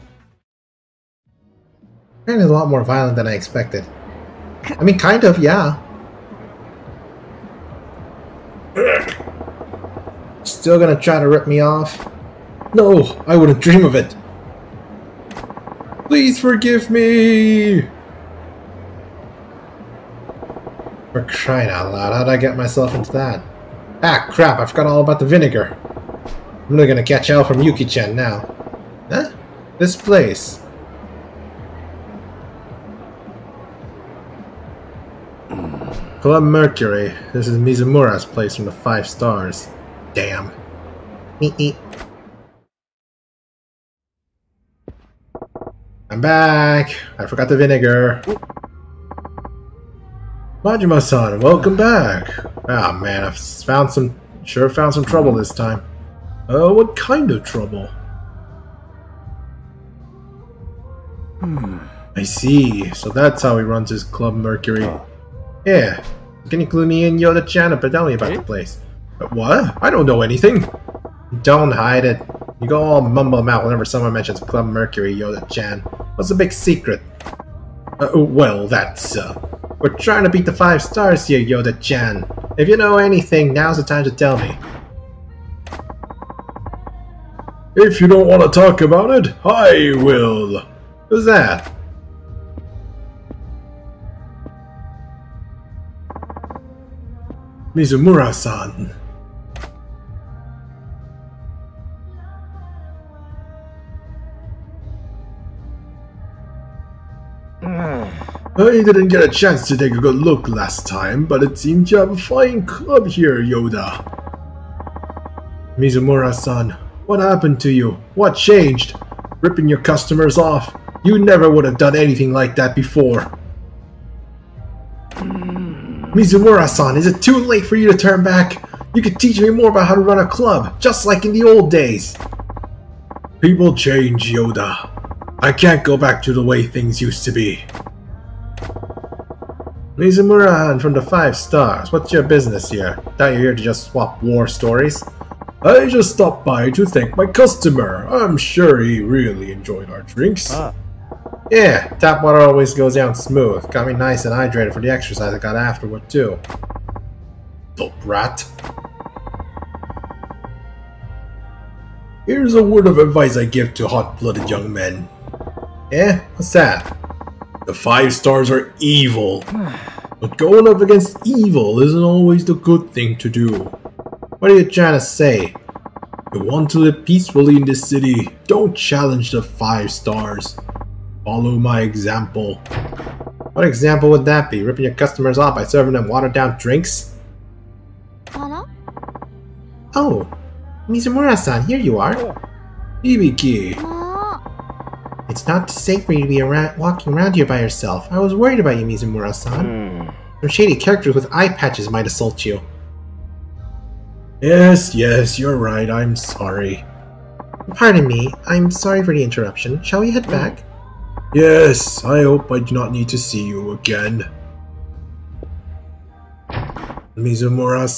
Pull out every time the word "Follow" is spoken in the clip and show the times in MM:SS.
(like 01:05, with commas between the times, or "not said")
03:01.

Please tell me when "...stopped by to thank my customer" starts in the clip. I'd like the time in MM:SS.
02:26.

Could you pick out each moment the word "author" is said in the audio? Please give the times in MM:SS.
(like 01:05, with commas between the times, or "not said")
not said.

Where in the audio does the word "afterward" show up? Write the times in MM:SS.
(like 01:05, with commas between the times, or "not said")
02:35.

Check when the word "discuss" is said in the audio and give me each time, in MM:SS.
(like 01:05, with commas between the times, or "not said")
not said.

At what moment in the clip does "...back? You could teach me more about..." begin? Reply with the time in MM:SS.
02:08.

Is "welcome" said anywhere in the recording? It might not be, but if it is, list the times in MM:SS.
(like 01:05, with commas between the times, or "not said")
00:51.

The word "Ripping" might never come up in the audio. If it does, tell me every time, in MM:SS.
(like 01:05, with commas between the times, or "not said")
01:59, 03:04.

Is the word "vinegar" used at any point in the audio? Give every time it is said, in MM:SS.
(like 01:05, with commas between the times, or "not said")
00:25, 00:47.